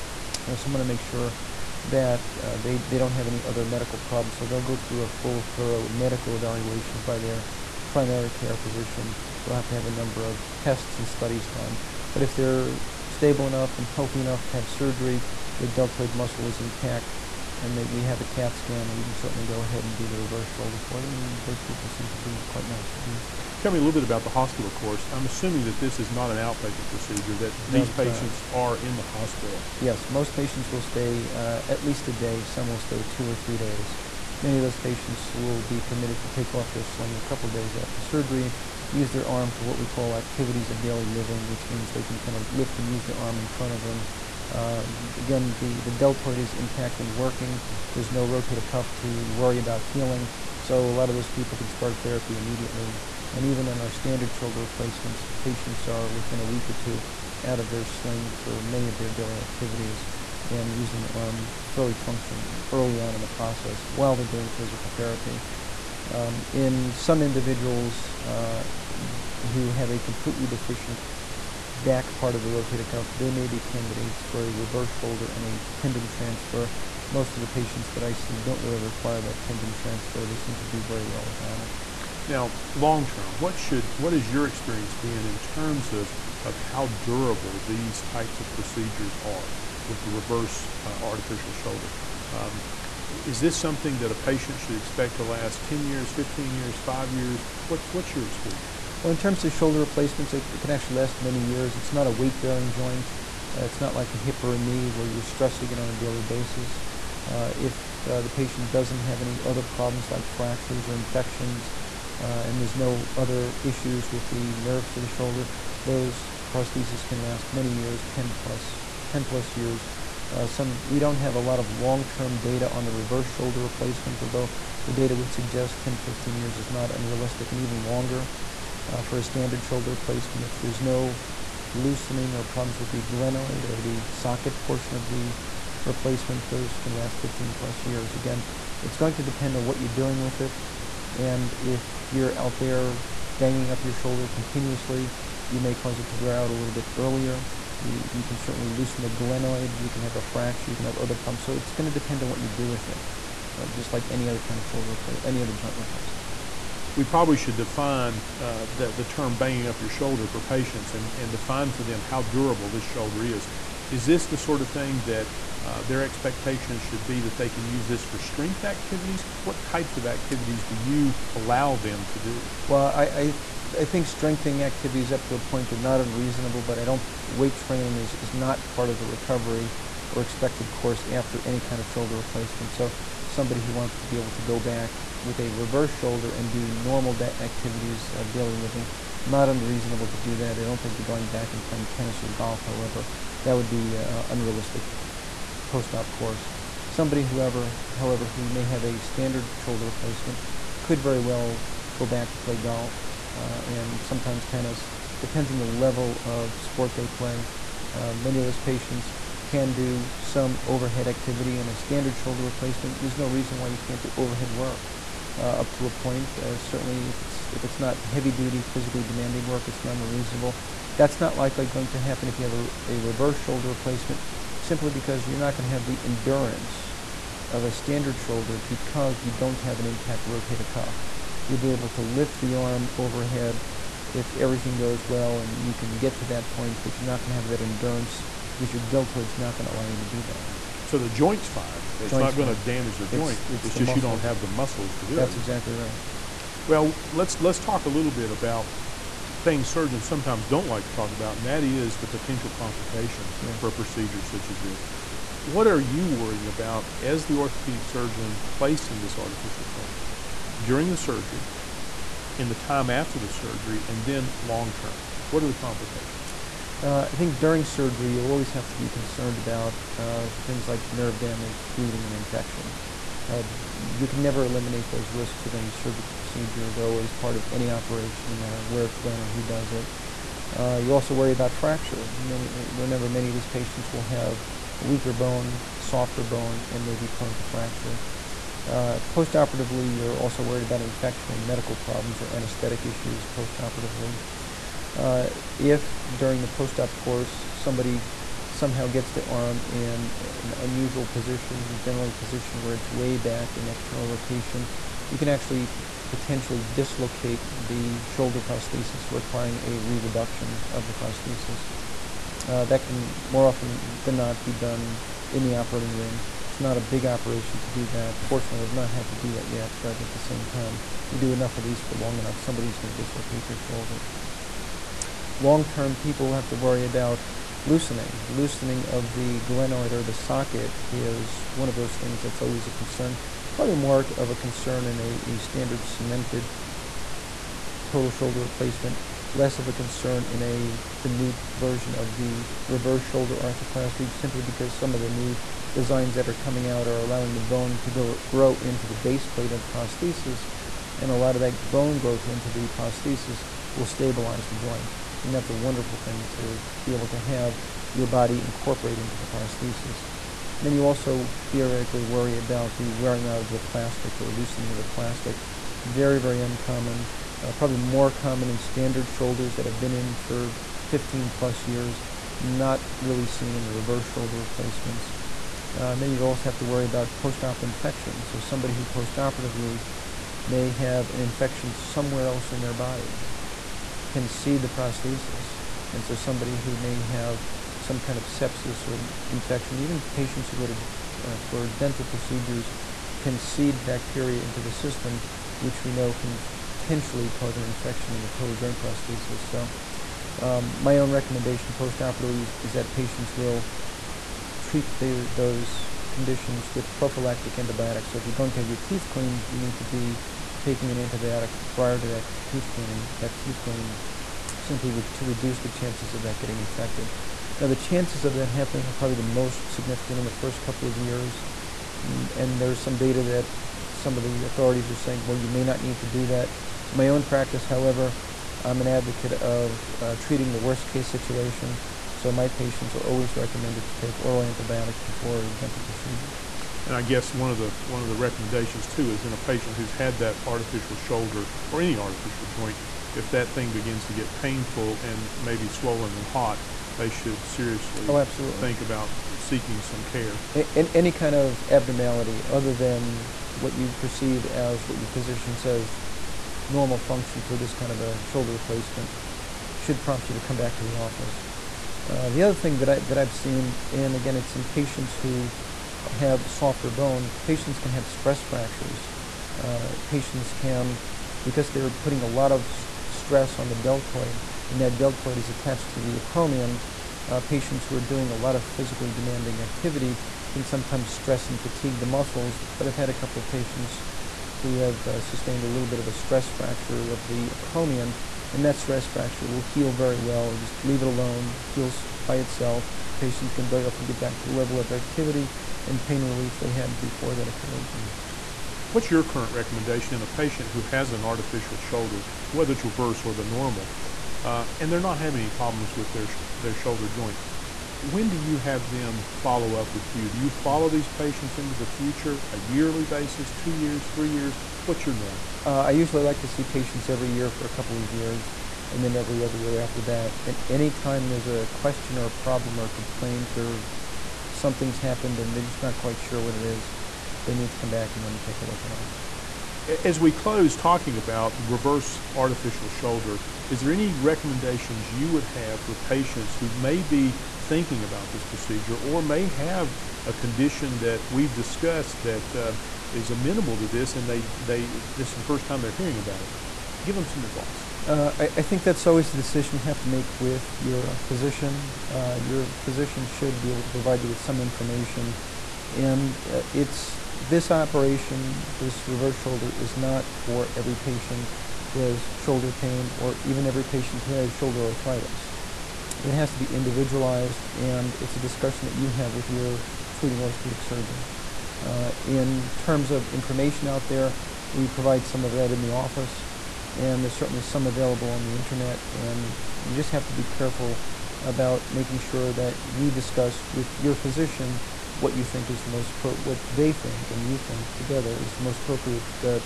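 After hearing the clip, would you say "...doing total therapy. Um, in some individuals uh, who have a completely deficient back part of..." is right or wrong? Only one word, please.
wrong.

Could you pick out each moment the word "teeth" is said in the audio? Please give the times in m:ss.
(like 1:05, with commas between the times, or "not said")
6:48, 6:53.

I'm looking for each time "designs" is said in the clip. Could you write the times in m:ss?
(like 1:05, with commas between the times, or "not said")
5:45.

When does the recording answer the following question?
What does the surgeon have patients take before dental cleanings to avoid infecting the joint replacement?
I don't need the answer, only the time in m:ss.
7:14.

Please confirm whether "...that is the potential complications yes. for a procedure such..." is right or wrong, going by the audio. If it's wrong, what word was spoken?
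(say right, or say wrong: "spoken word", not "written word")
right.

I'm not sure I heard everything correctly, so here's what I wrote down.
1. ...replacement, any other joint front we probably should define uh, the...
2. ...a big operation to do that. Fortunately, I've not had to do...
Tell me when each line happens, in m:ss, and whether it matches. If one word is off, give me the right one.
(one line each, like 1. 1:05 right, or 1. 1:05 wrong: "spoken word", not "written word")
1. 2:34 wrong: "replacement", not "front"
2. 5:16 right.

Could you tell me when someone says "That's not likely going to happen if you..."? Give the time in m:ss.
3:40.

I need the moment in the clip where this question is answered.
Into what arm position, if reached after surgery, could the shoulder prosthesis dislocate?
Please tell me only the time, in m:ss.
5:03.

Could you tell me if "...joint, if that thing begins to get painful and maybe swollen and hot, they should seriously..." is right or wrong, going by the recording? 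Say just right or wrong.
right.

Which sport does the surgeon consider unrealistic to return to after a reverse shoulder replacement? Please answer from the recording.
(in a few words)
tennis or golf.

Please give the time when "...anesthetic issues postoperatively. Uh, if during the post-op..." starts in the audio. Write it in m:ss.
4:52.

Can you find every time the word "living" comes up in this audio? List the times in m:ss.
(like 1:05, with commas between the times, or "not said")
0:41, 3:08.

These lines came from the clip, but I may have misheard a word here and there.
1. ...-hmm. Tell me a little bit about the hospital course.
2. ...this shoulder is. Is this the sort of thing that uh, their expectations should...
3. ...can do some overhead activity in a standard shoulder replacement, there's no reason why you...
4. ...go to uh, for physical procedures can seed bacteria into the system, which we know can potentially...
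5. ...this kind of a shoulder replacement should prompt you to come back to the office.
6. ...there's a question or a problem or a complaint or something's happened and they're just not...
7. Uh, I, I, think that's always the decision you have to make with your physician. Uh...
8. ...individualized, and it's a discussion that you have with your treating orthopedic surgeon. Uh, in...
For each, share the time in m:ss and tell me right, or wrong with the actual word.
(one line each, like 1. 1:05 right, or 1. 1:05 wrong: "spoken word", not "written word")
1. 0:23 right
2. 2:42 right
3. 3:29 right
4. 6:30 wrong: "dental", not "physical"
5. 7:37 right
6. 8:41 right
7. 9:08 right
8. 9:26 right.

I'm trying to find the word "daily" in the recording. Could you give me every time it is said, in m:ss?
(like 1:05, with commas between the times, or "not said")
0:40, 0:59, 1:45, 3:08.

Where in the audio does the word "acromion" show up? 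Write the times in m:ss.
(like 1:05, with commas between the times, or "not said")
7:56, 8:07.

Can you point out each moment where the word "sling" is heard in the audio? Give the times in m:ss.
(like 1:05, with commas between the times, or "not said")
0:36, 0:57.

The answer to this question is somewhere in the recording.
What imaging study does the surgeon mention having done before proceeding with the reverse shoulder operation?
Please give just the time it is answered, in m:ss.
0:18.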